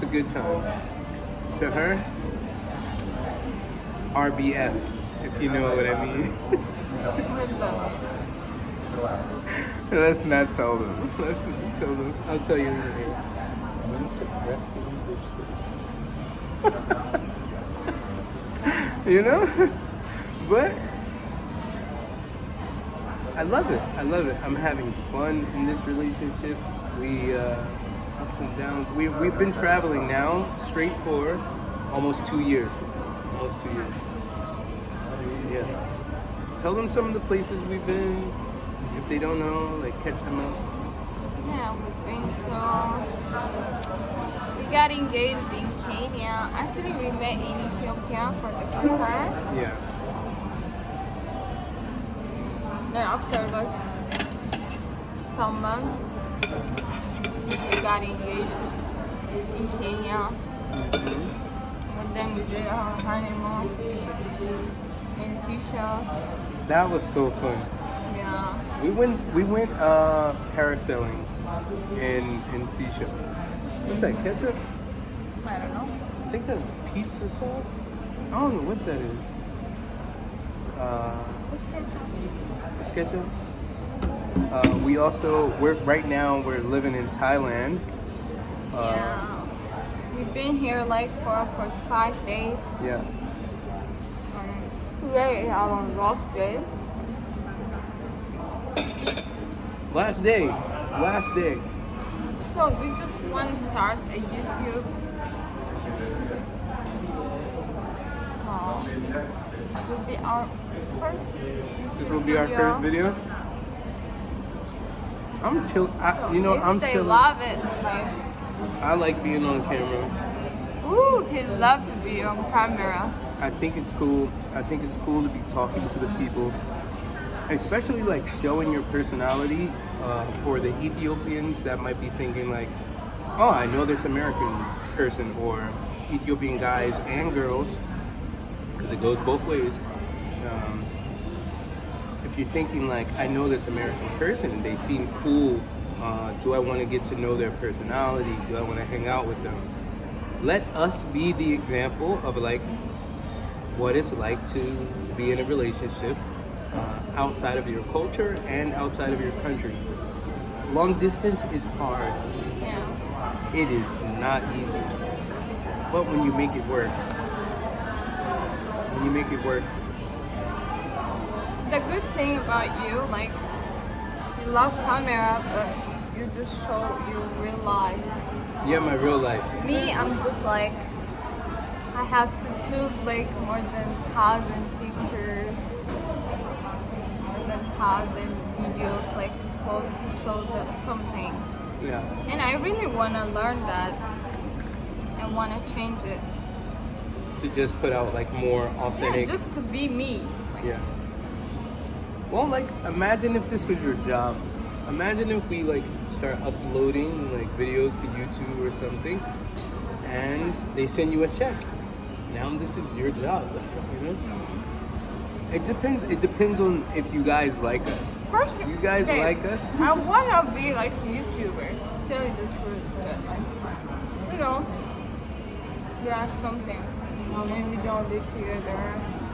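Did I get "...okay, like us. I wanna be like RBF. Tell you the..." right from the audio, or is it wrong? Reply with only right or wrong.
wrong.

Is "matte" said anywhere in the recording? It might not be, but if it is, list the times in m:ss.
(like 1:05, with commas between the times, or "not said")
not said.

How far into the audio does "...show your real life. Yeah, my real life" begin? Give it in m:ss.
2:56.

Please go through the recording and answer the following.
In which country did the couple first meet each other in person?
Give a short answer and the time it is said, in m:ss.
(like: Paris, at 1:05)
Ethiopia, at 0:47.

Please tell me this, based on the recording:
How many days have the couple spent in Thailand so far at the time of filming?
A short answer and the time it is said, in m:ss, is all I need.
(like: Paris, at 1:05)
5, at 1:31.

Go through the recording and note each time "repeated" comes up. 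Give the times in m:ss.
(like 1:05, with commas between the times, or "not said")
not said.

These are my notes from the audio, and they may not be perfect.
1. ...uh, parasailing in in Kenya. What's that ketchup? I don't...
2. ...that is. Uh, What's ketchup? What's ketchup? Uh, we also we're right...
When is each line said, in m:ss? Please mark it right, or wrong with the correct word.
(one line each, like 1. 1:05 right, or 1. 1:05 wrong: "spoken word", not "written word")
1. 1:09 wrong: "Seychelles", not "Kenya"
2. 1:18 right.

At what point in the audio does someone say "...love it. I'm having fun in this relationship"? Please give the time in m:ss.
0:24.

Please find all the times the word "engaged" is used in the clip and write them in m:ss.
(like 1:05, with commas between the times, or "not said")
0:44, 0:58.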